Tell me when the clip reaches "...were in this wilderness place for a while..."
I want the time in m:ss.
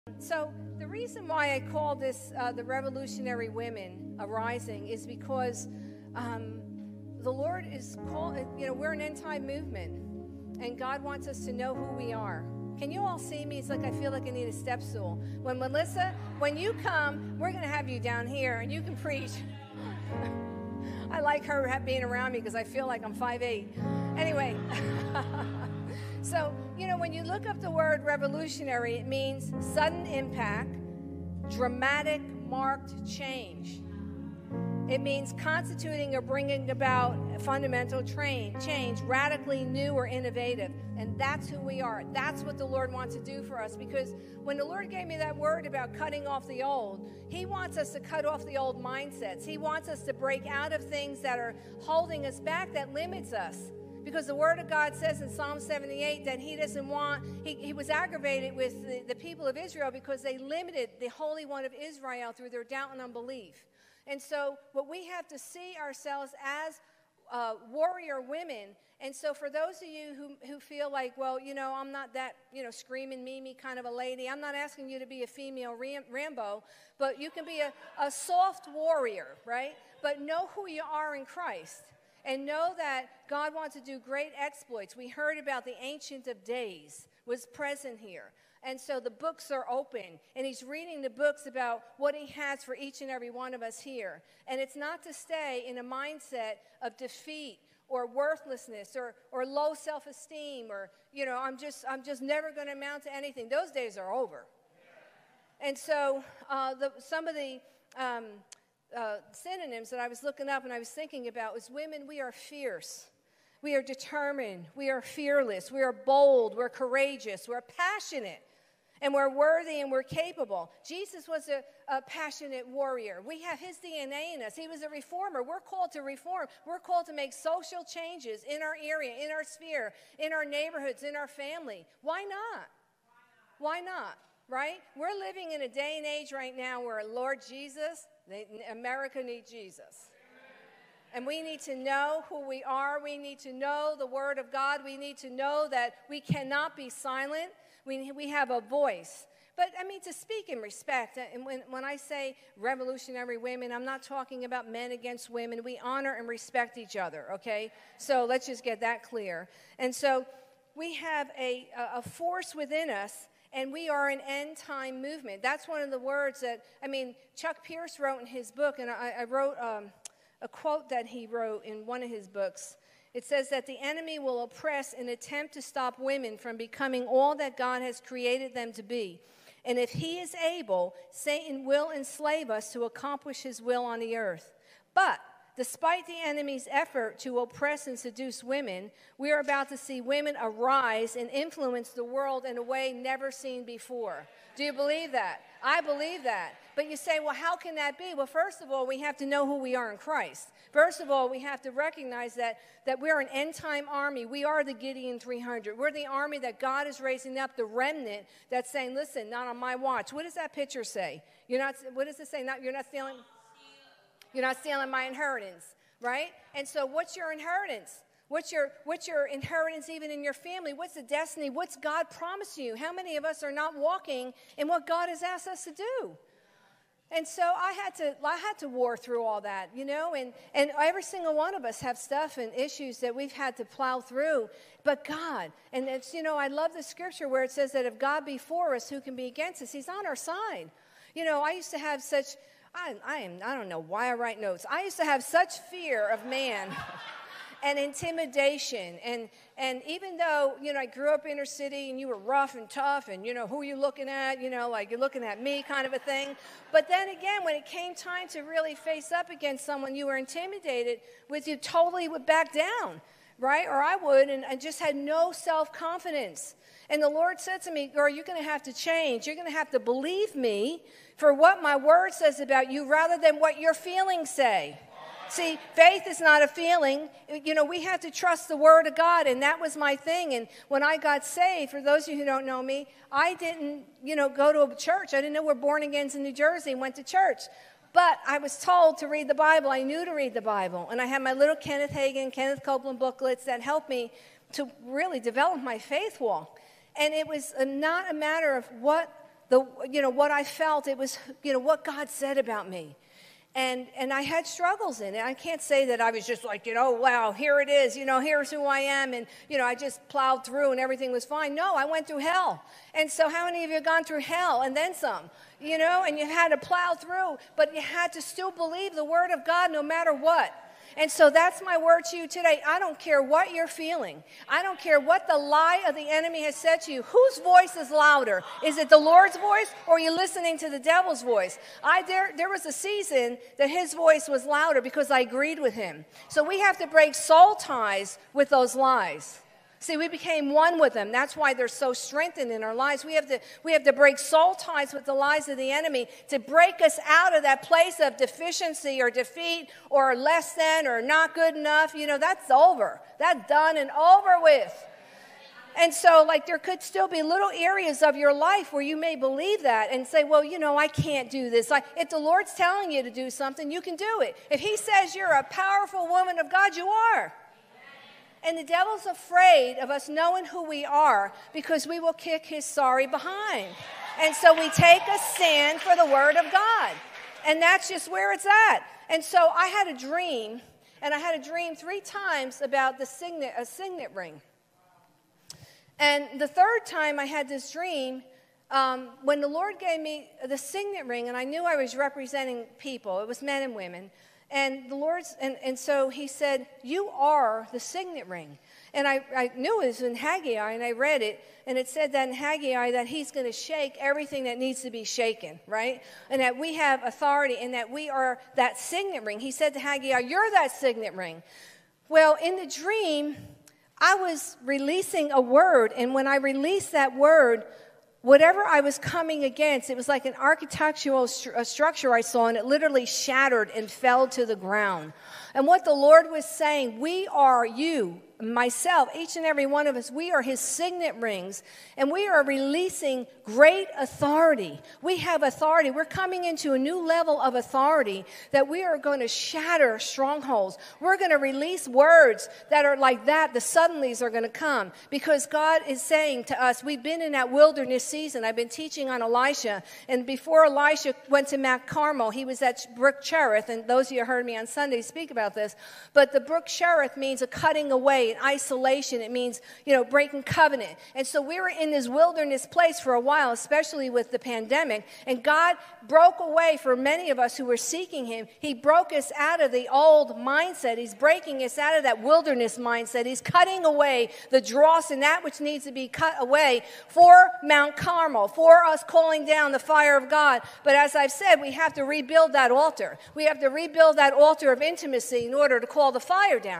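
7:41.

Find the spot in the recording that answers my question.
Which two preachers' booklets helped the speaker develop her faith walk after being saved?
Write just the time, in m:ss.
4:51.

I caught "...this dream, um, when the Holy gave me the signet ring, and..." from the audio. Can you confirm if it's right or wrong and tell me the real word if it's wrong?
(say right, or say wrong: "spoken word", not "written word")
wrong: "Lord", not "Holy".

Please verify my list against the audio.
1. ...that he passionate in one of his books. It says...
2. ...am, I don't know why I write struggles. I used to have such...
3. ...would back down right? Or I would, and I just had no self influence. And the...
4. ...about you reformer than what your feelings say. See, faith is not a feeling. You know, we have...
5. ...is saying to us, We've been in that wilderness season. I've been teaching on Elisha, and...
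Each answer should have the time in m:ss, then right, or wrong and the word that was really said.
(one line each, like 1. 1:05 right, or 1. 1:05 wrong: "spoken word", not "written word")
1. 2:50 wrong: "wrote", not "passionate"
2. 4:03 wrong: "notes", not "struggles"
3. 4:22 wrong: "confidence", not "influence"
4. 4:32 wrong: "rather", not "reformer"
5. 7:25 right.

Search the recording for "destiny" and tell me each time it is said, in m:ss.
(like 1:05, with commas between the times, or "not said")
3:41.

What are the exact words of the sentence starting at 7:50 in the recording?
He's breaking us out of that wilderness mindset.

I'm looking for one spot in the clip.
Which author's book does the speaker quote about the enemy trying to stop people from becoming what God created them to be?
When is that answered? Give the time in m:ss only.
2:47.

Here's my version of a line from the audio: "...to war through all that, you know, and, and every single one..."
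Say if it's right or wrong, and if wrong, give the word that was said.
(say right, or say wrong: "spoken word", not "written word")
right.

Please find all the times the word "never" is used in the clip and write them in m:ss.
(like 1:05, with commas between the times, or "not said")
1:42, 3:12.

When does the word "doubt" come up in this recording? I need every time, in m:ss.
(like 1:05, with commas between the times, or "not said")
1:02.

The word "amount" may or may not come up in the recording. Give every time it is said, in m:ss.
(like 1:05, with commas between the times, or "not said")
1:42.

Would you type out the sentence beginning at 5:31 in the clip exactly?
I there there was a season that his voice was louder because I agreed with him.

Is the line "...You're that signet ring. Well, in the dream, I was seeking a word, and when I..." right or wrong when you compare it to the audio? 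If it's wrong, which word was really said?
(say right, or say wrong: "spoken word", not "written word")
wrong: "releasing", not "seeking".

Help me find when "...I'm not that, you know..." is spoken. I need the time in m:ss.
1:11.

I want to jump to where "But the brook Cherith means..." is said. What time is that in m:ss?
7:36.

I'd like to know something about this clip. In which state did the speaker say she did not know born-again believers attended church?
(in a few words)
New Jersey.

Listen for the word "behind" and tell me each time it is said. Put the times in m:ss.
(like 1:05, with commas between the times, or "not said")
6:13.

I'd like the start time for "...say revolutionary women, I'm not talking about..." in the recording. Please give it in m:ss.
2:31.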